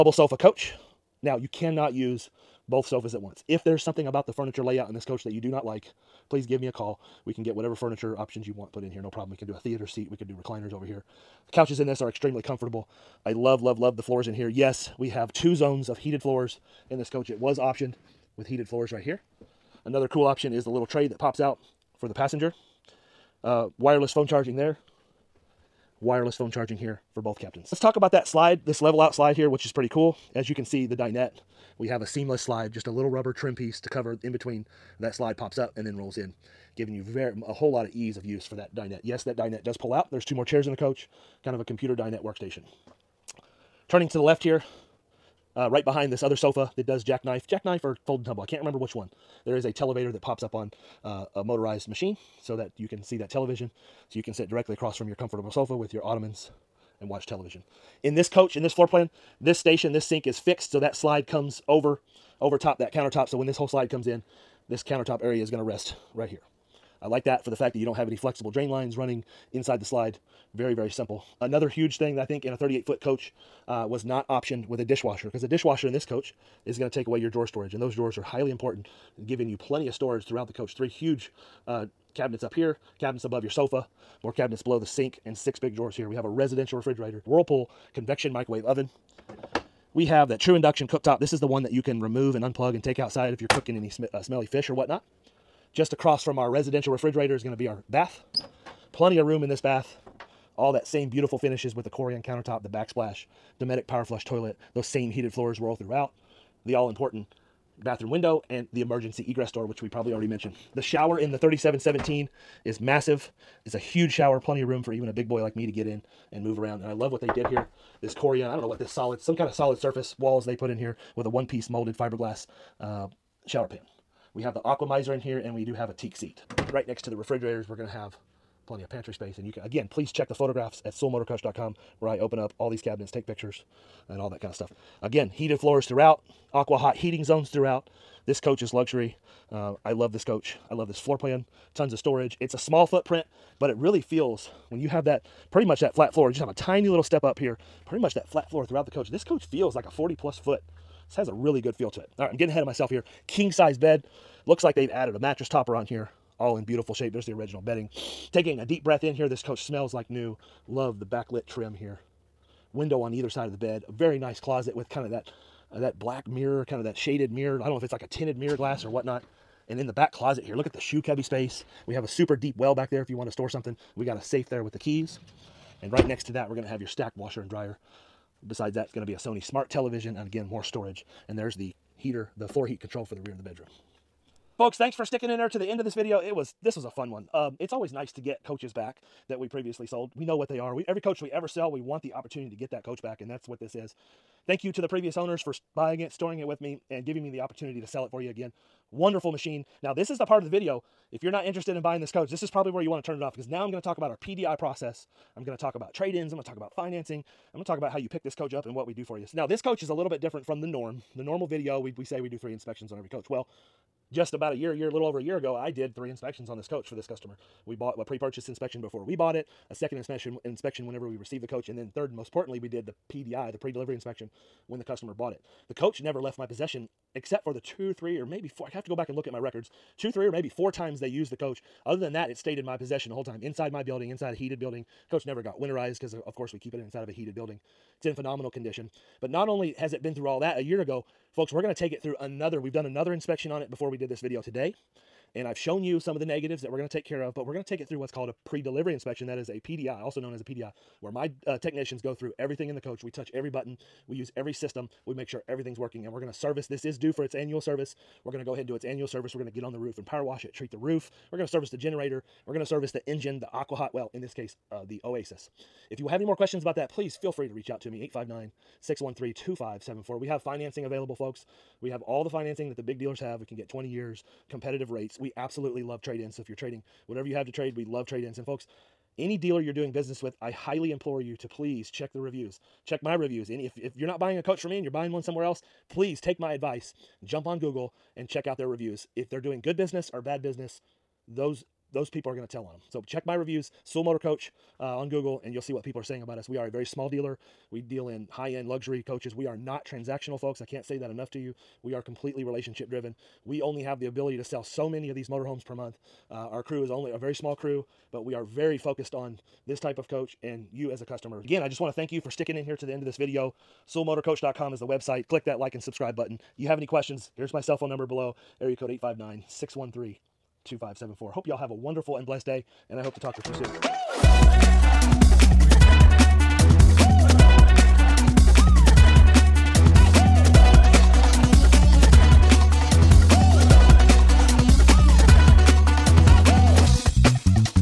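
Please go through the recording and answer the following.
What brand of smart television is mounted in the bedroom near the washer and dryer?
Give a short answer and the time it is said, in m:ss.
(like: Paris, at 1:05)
Sony, at 2:59.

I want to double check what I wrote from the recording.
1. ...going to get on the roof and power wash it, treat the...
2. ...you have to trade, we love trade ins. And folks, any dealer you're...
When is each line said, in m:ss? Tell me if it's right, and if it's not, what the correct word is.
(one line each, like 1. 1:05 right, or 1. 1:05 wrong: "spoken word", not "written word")
1. 4:19 right
2. 4:37 right.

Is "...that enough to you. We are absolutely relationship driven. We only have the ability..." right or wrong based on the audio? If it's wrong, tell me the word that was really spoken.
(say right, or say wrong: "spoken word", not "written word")
wrong: "completely", not "absolutely".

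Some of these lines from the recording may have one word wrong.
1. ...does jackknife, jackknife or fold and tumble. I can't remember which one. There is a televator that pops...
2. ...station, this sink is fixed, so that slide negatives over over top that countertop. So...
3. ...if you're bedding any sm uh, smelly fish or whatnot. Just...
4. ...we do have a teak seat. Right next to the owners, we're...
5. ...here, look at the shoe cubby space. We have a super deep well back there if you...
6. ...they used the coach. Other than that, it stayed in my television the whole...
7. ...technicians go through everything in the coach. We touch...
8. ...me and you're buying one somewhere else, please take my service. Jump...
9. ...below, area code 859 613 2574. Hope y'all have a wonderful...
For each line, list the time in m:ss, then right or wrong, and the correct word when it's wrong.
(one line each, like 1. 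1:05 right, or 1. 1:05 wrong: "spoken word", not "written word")
1. 0:46 right
2. 0:59 wrong: "comes", not "negatives"
3. 1:33 wrong: "cooking", not "bedding"
4. 2:05 wrong: "refrigerators", not "owners"
5. 2:50 right
6. 3:50 wrong: "possession", not "television"
7. 4:11 right
8. 4:44 wrong: "advice", not "service"
9. 5:18 right.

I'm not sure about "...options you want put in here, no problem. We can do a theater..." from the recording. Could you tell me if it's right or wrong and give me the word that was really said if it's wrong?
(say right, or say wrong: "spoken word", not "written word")
right.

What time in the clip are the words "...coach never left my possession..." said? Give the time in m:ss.
3:45.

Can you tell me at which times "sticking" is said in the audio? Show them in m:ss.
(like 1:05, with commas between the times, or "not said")
3:05, 5:12.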